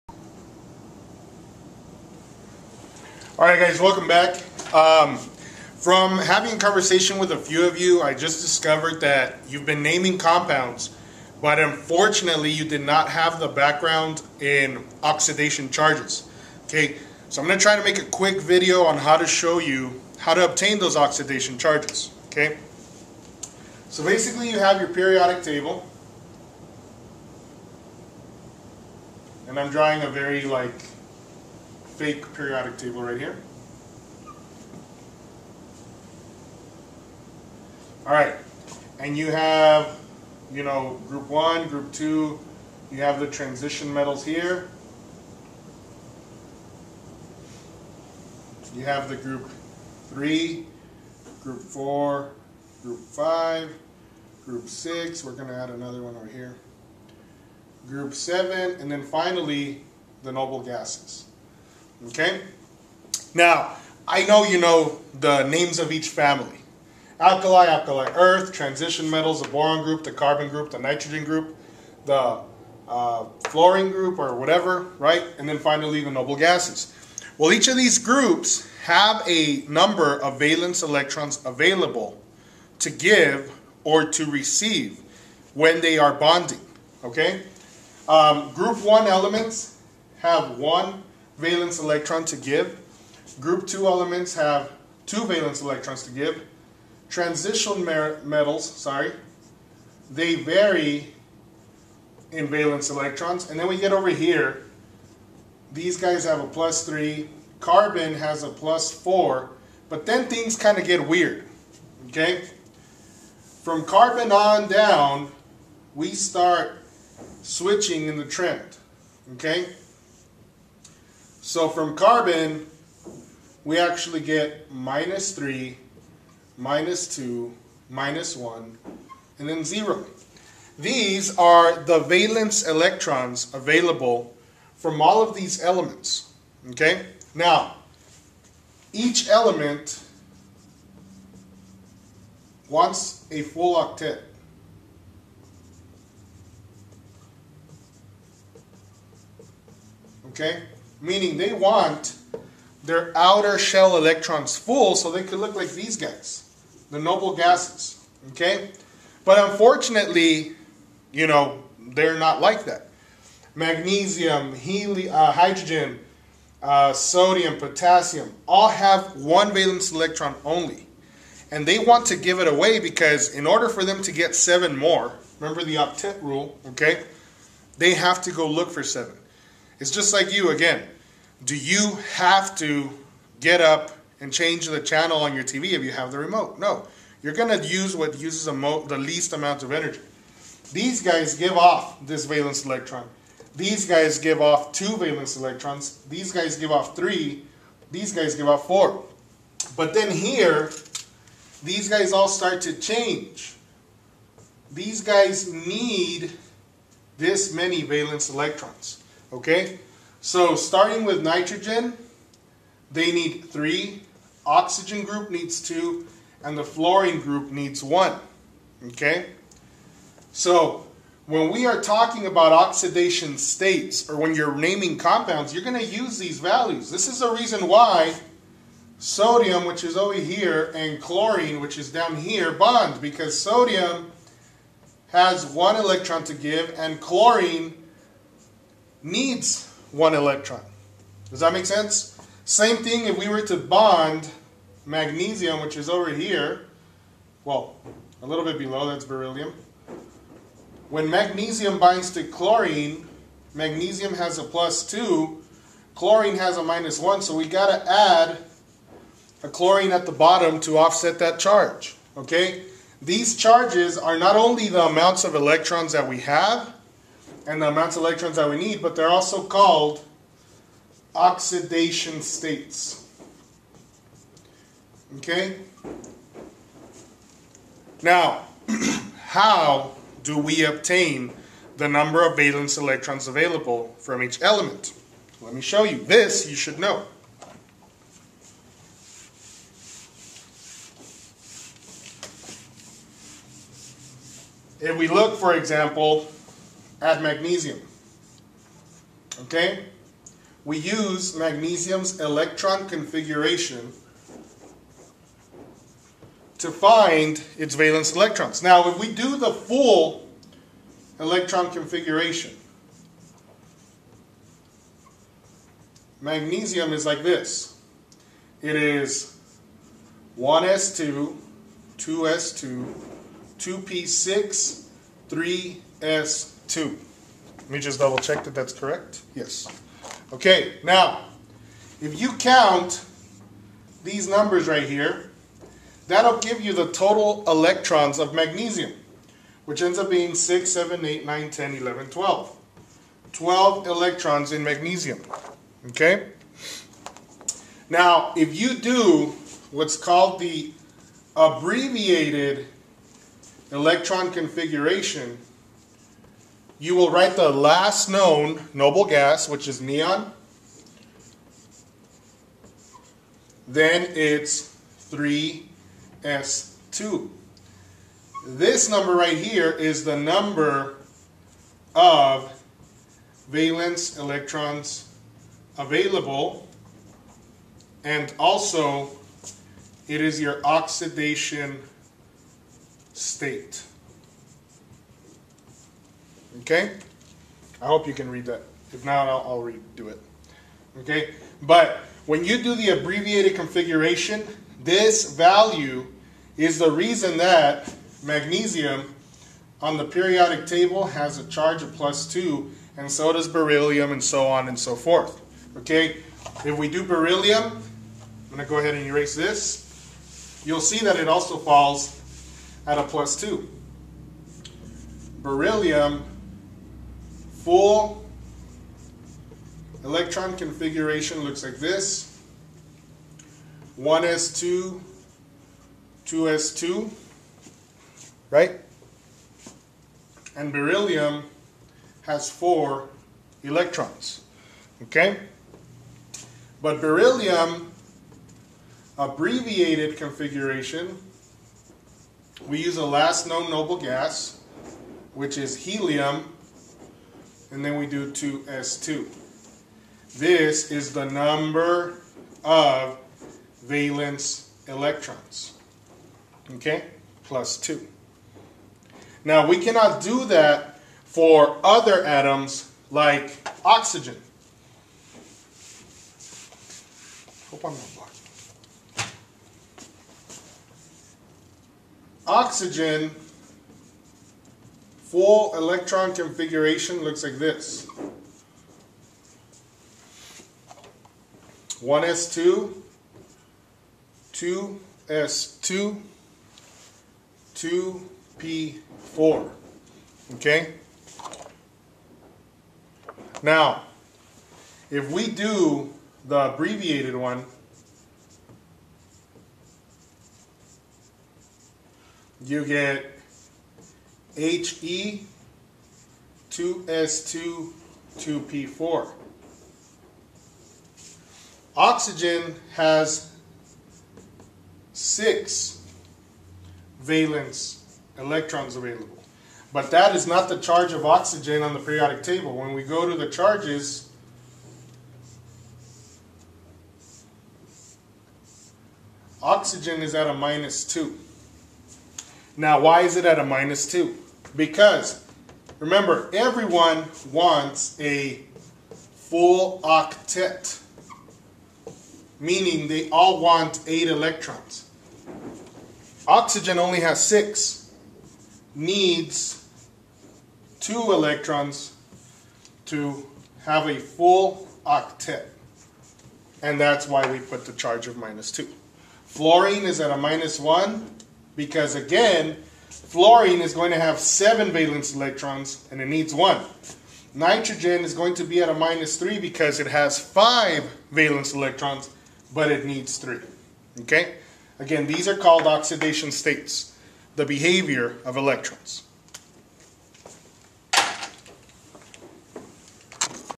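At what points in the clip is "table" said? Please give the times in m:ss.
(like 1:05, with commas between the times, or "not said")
0:25, 0:32, 6:40, 8:42.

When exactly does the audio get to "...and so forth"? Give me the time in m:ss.
6:44.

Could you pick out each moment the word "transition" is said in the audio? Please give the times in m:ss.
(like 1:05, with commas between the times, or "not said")
0:43, 1:08, 1:37.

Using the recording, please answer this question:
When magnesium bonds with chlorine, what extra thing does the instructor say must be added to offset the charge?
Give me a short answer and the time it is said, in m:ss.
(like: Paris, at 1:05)
a chlorine, at 4:17.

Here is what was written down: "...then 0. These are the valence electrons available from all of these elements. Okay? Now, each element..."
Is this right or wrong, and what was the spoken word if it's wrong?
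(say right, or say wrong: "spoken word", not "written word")
right.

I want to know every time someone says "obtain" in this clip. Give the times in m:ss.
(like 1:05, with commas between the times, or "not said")
0:20, 4:40.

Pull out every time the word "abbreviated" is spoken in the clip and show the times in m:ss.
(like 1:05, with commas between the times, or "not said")
5:51, 6:32, 7:19, 8:16.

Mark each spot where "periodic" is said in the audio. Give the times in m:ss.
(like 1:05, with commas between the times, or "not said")
0:24, 0:32, 6:40, 8:41.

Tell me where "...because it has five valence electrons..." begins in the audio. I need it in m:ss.
9:29.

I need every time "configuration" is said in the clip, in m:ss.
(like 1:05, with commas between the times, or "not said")
5:02, 5:11, 5:54, 6:33, 7:00, 7:20, 7:56.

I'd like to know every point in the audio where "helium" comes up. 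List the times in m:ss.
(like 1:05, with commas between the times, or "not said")
2:44, 7:25.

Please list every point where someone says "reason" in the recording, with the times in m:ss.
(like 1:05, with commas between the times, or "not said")
3:47, 6:36.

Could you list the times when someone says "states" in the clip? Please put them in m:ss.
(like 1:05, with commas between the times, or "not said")
3:43, 4:32, 6:23, 9:36.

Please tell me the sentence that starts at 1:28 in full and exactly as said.
Um, group 1 elements have one valence electron to give.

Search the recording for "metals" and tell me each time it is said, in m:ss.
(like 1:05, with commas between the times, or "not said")
0:43, 1:09, 1:37.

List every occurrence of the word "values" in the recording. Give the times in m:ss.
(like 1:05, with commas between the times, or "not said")
3:46, 6:35.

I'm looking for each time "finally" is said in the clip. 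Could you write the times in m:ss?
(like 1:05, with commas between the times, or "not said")
0:59, 1:15.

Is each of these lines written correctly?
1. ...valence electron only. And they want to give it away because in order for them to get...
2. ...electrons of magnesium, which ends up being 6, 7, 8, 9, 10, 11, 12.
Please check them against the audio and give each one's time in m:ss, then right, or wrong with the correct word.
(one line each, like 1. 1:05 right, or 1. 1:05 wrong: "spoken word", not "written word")
1. 2:49 right
2. 5:37 right.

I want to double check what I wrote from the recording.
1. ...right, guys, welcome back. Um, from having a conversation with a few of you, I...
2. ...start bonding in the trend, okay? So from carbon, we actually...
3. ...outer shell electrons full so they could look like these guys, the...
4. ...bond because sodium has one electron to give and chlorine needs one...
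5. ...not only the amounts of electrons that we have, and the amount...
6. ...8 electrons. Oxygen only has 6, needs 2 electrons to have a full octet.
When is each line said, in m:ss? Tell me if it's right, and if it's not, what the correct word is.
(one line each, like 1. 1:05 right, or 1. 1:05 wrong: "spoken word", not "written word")
1. 0:03 right
2. 1:56 wrong: "switching", not "bonding"
3. 2:33 right
4. 3:52 right
5. 4:24 right
6. 9:04 right.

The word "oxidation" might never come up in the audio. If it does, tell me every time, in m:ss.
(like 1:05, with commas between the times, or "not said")
0:15, 0:20, 3:42, 4:31, 6:20, 9:35.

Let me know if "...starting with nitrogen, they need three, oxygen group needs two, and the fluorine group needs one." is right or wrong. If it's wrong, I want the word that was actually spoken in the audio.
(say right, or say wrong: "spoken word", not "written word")
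right.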